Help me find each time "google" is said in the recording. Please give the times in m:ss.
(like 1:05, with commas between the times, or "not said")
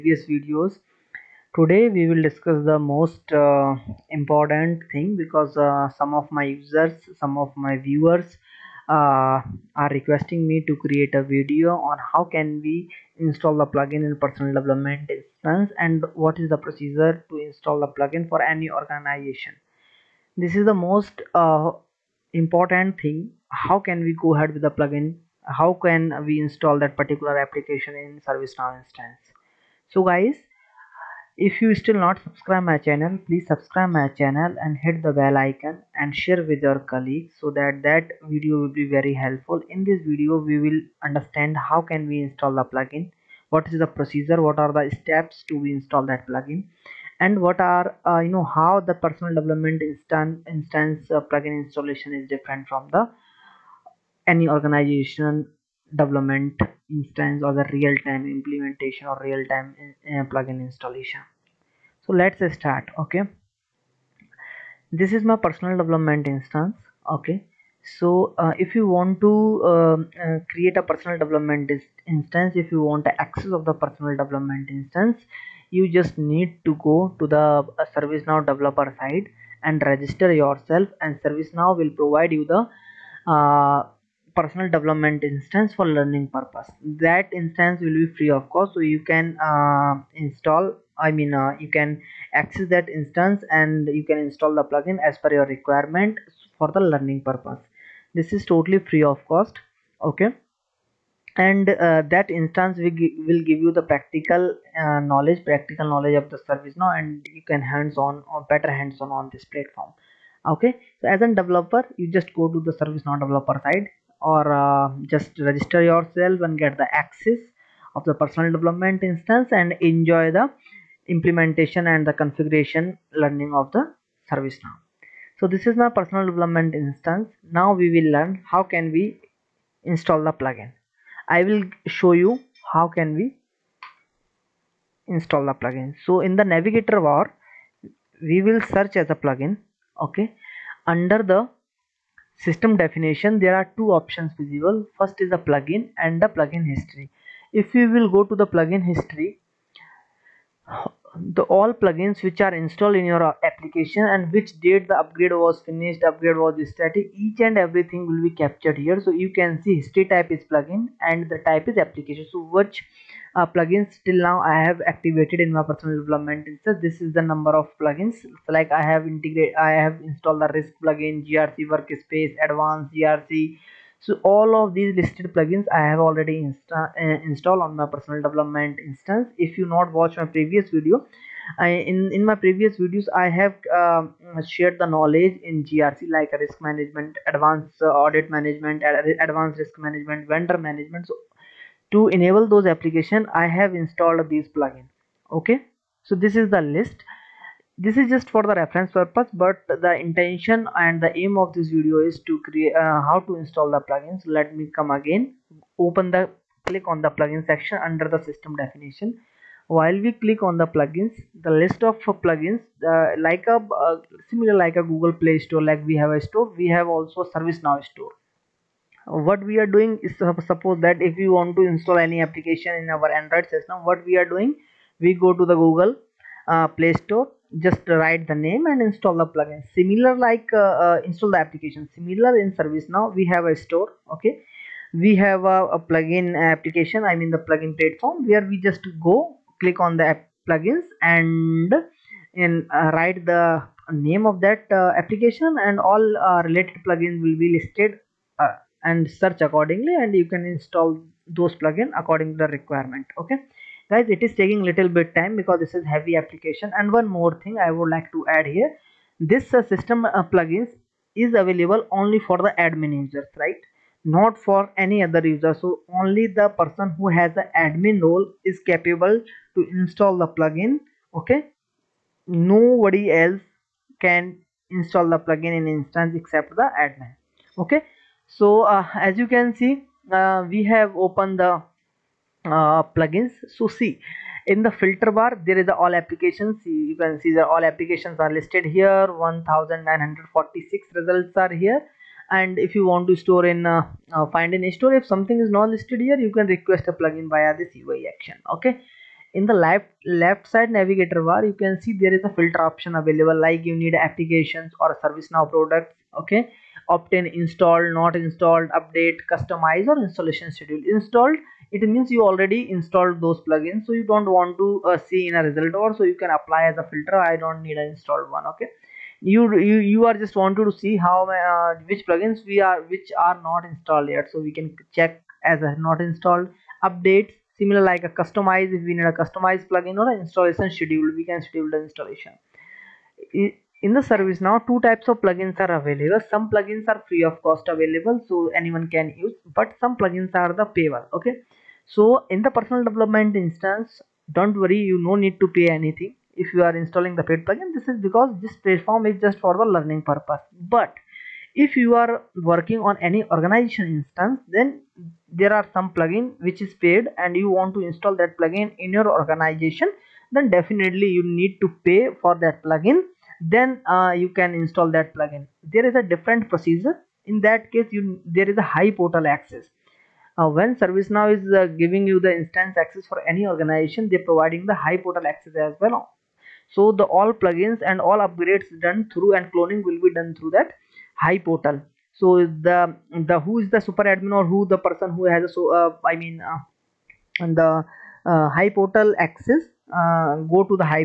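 3:34, 3:45.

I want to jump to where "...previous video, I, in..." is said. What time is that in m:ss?
3:00.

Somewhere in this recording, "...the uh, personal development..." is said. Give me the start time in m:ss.
1:22.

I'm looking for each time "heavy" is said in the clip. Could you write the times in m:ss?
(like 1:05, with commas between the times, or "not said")
4:15.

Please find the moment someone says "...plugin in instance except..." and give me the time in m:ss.
4:35.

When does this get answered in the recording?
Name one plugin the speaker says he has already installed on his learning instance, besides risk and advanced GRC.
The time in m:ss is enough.
2:51.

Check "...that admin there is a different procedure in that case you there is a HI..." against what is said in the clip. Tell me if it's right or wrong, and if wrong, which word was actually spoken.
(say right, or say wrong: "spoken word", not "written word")
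wrong: "plugin", not "admin".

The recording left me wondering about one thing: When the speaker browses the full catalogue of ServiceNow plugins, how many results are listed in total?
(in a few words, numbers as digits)
1946.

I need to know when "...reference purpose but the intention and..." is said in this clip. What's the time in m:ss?
3:18.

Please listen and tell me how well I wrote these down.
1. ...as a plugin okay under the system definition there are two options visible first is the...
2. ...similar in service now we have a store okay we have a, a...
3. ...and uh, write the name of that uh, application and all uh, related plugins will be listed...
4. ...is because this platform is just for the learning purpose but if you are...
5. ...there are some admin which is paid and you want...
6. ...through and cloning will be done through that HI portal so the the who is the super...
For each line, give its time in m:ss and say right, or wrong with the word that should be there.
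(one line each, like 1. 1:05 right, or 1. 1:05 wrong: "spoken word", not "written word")
1. 2:18 right
2. 3:51 right
3. 4:02 right
4. 5:47 right
5. 5:55 wrong: "plugin", not "admin"
6. 6:19 right.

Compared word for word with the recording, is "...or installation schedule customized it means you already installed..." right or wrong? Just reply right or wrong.
wrong.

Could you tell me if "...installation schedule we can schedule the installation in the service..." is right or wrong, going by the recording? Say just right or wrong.
right.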